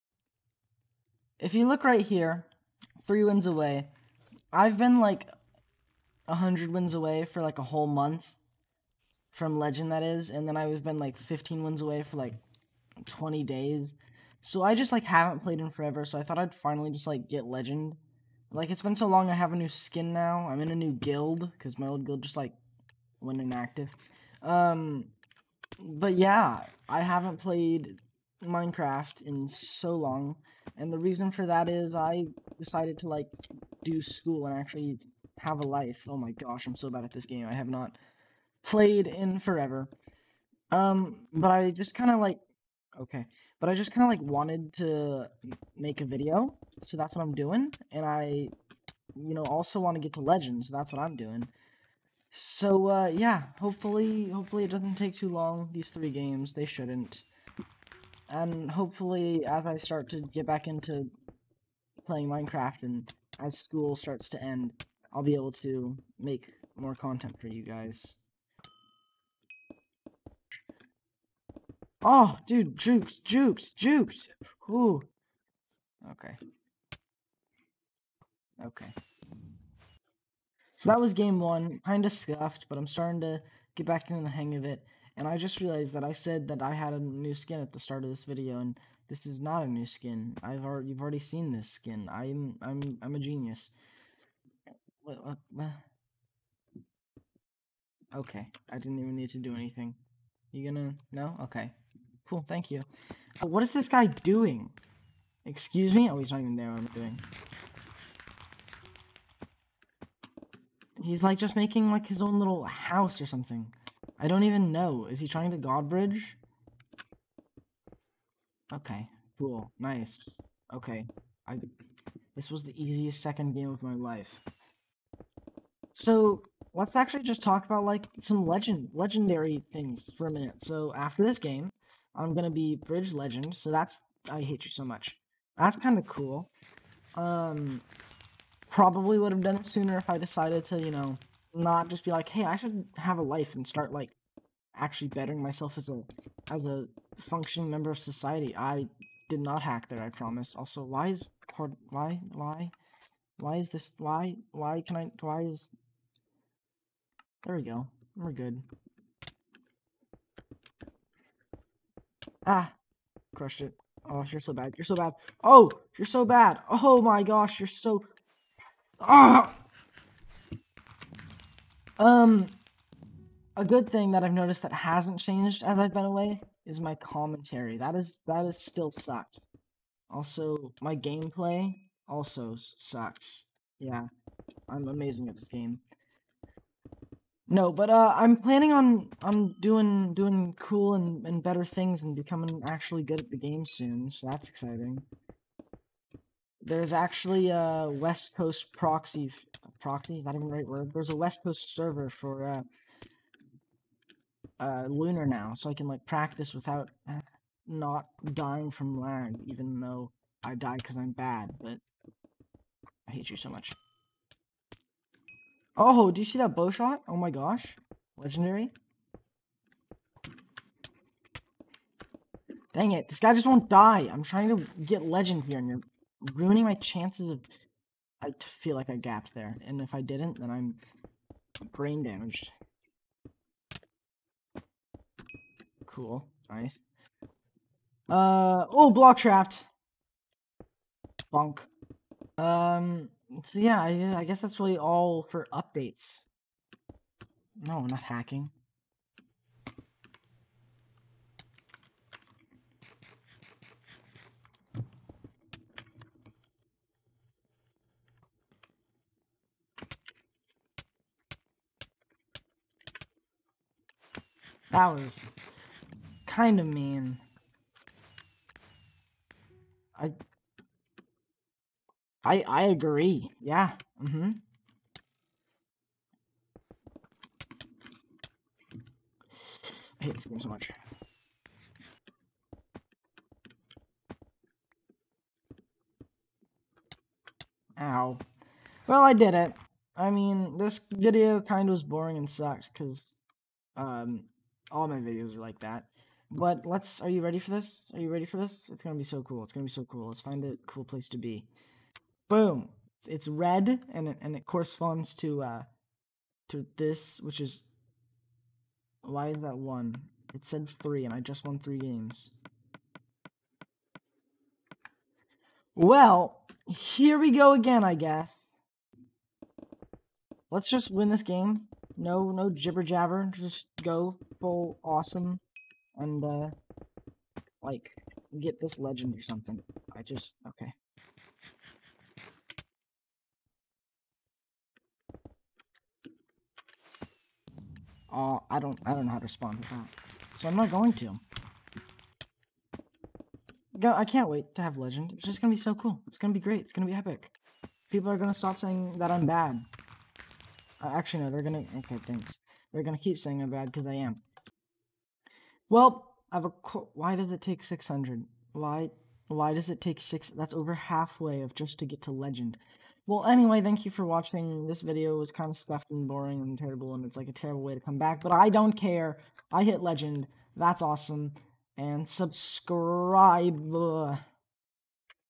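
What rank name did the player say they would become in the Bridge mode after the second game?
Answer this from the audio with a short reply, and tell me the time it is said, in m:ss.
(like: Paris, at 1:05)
Bridge Legend, at 2:12.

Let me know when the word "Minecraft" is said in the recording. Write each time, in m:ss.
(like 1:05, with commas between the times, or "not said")
0:28, 1:02.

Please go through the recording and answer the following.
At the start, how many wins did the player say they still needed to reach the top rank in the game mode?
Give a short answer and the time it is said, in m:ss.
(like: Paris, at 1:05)
3, at 0:03.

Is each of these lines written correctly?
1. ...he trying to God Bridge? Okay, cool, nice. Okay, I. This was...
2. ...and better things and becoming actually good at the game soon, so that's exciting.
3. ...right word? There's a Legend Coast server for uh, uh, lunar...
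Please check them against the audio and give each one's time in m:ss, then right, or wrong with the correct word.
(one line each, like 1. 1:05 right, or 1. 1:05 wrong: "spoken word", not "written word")
1. 1:55 right
2. 3:11 right
3. 3:20 wrong: "West", not "Legend".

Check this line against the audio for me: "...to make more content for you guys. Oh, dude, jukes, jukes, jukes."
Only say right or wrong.
right.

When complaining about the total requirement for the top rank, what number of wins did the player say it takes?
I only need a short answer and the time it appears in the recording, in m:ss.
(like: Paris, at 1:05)
600, at 5:57.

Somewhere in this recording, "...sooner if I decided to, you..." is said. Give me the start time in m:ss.
2:19.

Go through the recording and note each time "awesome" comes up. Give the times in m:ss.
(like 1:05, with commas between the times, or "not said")
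5:24, 6:10.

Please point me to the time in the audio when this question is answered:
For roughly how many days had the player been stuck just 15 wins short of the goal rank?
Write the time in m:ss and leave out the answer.
0:13.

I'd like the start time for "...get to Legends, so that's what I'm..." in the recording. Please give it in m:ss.
0:50.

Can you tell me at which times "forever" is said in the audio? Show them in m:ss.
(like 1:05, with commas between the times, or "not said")
0:15, 0:39.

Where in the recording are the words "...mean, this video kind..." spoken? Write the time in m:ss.
4:50.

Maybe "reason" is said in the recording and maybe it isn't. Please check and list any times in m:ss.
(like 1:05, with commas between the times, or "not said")
0:30.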